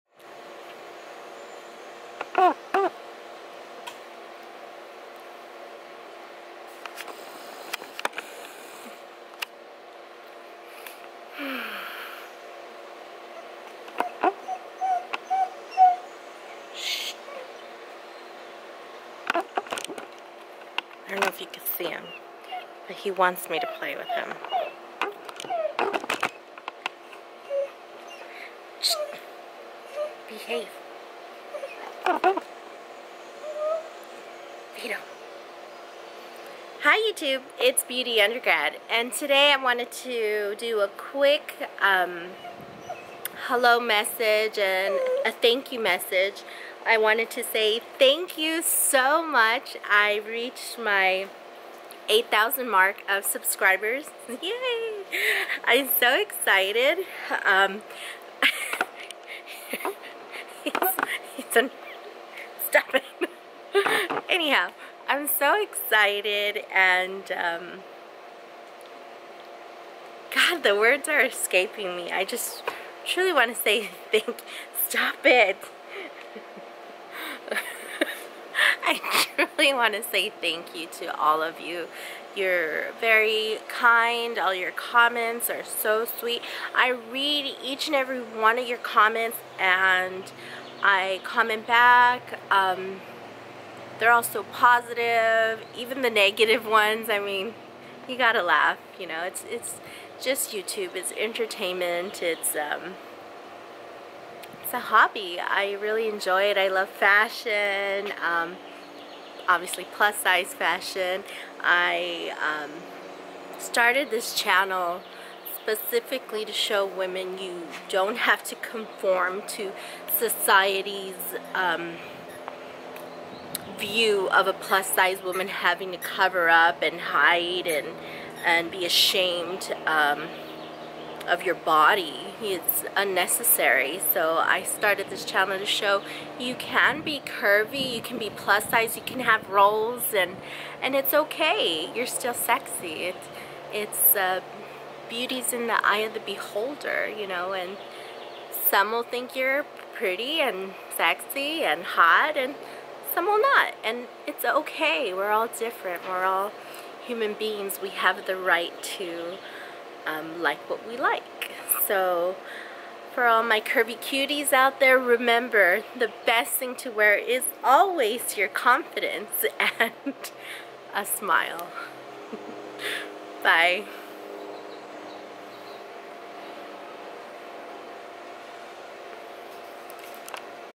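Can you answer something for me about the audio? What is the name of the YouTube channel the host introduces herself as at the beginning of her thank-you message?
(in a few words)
Beauty Undergrad.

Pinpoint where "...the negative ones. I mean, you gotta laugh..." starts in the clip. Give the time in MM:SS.
01:36.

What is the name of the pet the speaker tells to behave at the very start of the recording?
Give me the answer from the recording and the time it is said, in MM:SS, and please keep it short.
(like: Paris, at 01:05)
Vito, at 00:32.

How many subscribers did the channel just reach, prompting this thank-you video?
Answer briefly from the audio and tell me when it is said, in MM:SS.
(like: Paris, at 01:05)
8,000, at 00:52.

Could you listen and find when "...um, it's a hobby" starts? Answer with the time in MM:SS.
01:42.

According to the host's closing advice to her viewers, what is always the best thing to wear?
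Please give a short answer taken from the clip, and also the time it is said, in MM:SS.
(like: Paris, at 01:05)
Confidence, at 02:48.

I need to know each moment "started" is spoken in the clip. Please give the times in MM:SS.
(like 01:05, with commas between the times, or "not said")
01:53, 02:14.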